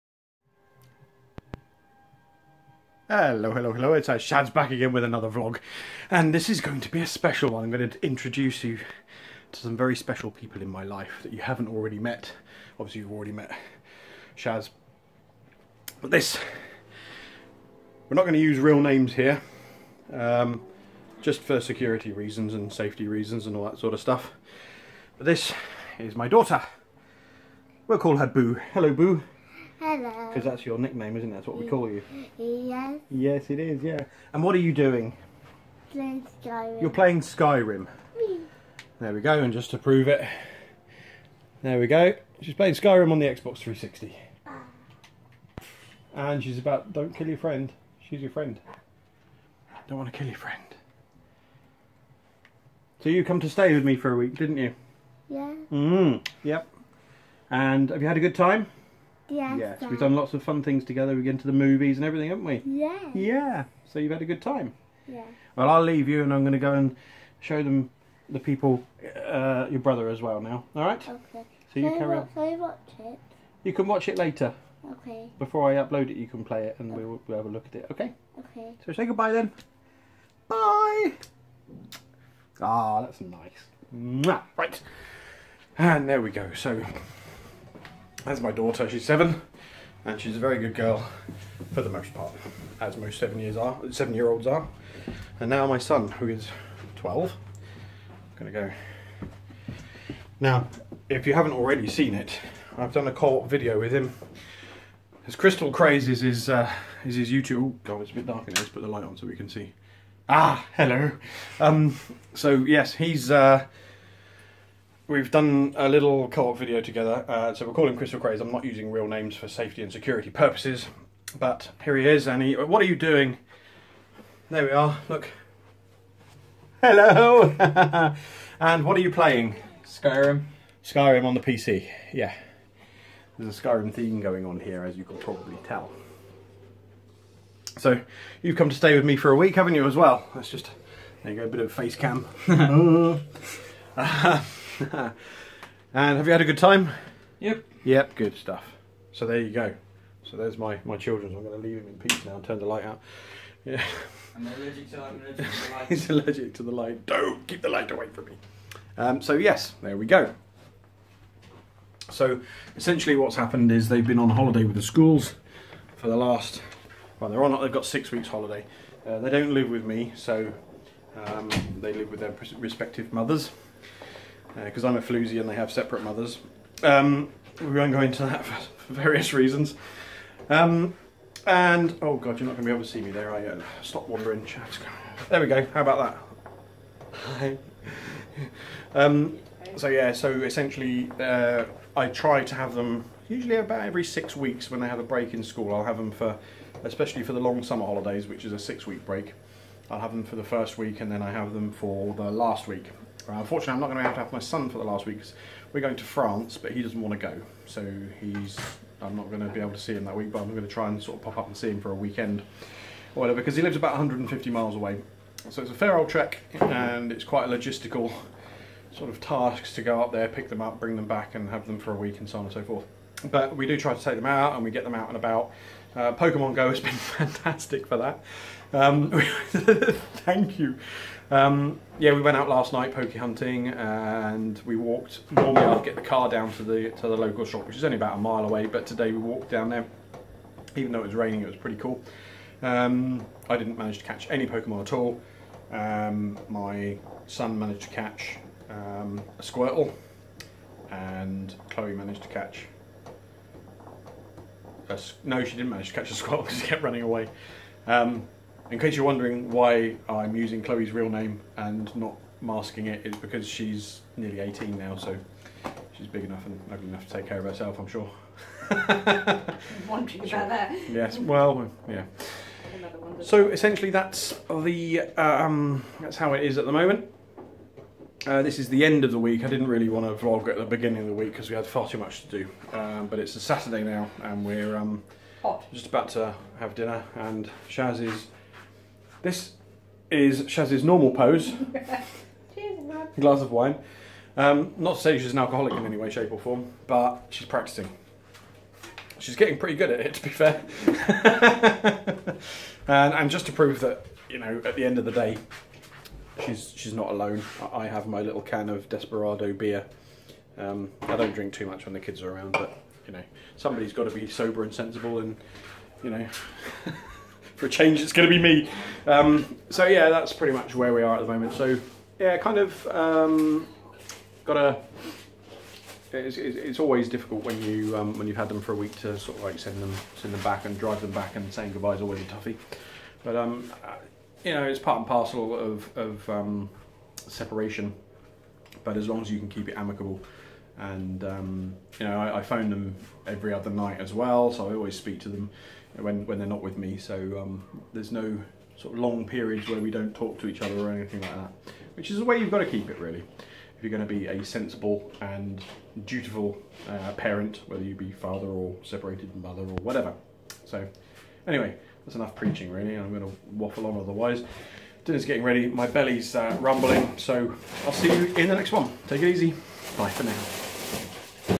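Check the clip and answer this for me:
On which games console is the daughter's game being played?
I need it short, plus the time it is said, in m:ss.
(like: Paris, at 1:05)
Xbox 360, at 0:43.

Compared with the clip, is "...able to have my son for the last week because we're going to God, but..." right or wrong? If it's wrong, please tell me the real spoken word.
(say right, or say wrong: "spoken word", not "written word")
wrong: "France", not "God".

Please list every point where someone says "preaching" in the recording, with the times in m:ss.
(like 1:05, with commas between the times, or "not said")
6:02.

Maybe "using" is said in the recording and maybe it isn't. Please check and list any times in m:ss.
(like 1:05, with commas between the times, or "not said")
1:58, 4:20.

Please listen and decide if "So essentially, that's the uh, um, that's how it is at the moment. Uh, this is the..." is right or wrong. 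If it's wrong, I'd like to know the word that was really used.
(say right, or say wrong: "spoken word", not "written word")
right.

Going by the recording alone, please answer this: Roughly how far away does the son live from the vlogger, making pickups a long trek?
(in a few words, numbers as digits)
150 miles.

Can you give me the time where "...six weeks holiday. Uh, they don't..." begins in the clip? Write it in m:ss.
2:47.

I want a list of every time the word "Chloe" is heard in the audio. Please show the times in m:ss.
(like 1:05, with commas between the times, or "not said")
4:11, 4:20.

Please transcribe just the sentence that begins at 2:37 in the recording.
Don't keep the light away from me.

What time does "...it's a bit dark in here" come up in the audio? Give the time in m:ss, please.
1:48.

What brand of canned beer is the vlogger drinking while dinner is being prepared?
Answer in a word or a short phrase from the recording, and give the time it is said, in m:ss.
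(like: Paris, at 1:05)
Desperado, at 5:08.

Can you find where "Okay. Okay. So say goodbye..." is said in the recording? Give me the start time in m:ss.
1:17.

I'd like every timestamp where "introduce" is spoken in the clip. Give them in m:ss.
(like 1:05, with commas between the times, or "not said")
0:08.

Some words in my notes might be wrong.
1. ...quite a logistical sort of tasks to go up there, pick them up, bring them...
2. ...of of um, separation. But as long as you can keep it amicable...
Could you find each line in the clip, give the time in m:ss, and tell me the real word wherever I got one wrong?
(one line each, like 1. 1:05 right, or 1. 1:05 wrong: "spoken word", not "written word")
1. 3:37 right
2. 5:35 right.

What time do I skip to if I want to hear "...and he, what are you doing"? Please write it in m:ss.
2:02.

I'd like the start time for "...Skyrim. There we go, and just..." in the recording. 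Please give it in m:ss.
0:37.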